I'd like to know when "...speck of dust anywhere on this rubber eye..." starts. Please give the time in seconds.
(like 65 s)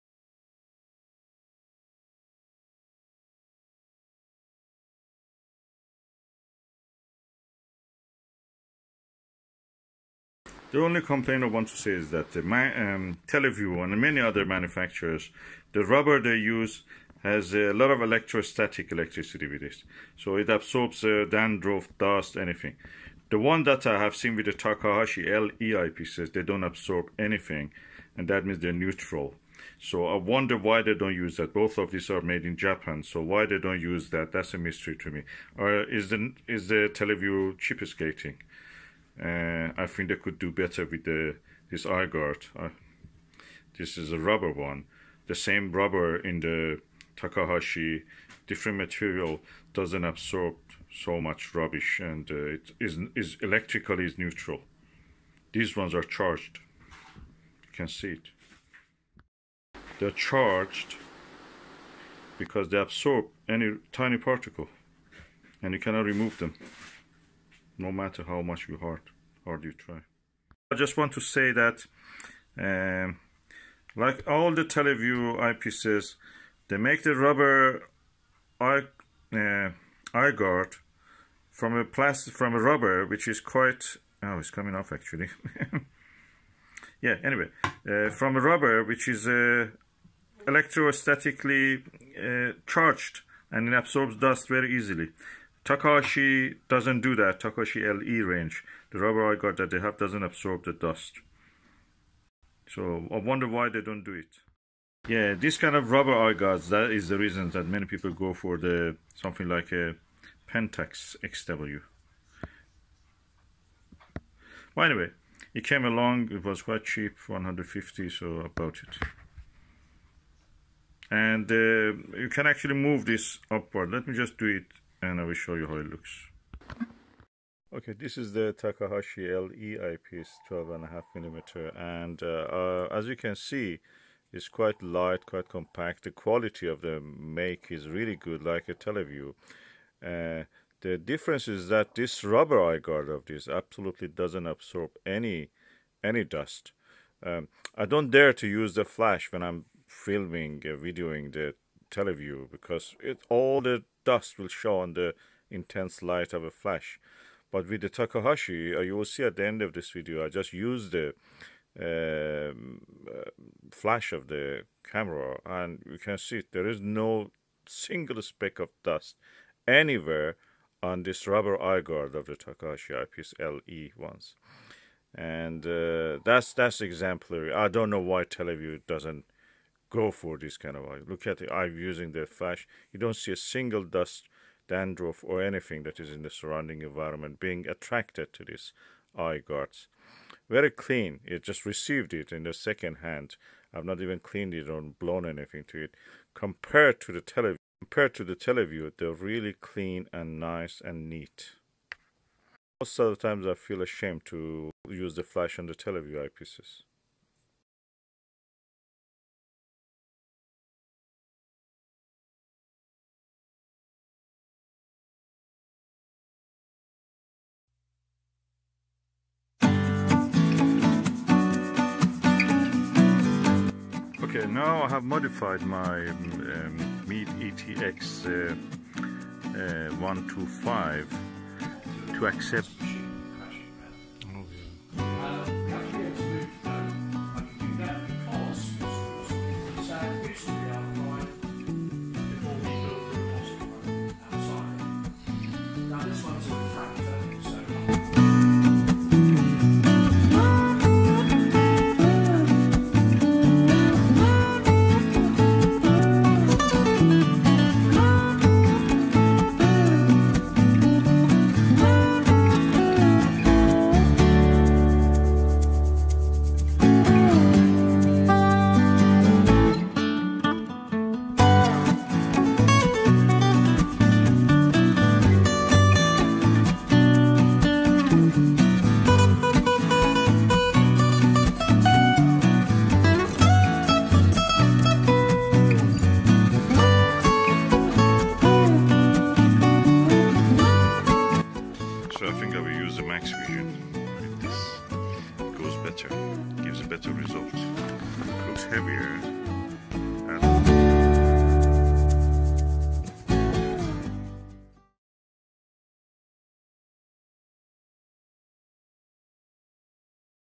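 168 s.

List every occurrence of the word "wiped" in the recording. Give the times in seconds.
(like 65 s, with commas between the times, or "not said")
not said.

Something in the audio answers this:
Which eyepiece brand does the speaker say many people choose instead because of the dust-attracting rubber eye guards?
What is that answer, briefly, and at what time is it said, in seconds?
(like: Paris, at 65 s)
Pentax XW, at 110 s.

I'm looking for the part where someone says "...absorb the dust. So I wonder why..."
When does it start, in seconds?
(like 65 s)
100 s.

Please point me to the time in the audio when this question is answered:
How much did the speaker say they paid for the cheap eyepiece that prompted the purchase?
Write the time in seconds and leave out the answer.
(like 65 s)
117 s.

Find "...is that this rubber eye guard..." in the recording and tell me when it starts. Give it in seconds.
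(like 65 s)
141 s.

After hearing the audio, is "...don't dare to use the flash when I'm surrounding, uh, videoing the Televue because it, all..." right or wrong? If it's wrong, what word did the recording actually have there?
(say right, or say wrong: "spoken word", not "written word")
wrong: "filming", not "surrounding".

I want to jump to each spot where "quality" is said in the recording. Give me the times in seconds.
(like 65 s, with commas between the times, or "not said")
136 s.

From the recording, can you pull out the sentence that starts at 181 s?
Look at the eye using the flash.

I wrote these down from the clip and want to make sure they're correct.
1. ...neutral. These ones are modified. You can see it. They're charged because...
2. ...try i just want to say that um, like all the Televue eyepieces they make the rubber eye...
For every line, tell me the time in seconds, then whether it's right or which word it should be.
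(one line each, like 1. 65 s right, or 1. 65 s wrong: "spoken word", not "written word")
1. 54 s wrong: "charged", not "modified"
2. 69 s right.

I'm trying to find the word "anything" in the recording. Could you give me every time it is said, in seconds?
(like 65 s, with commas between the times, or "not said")
22 s, 27 s, 185 s, 195 s.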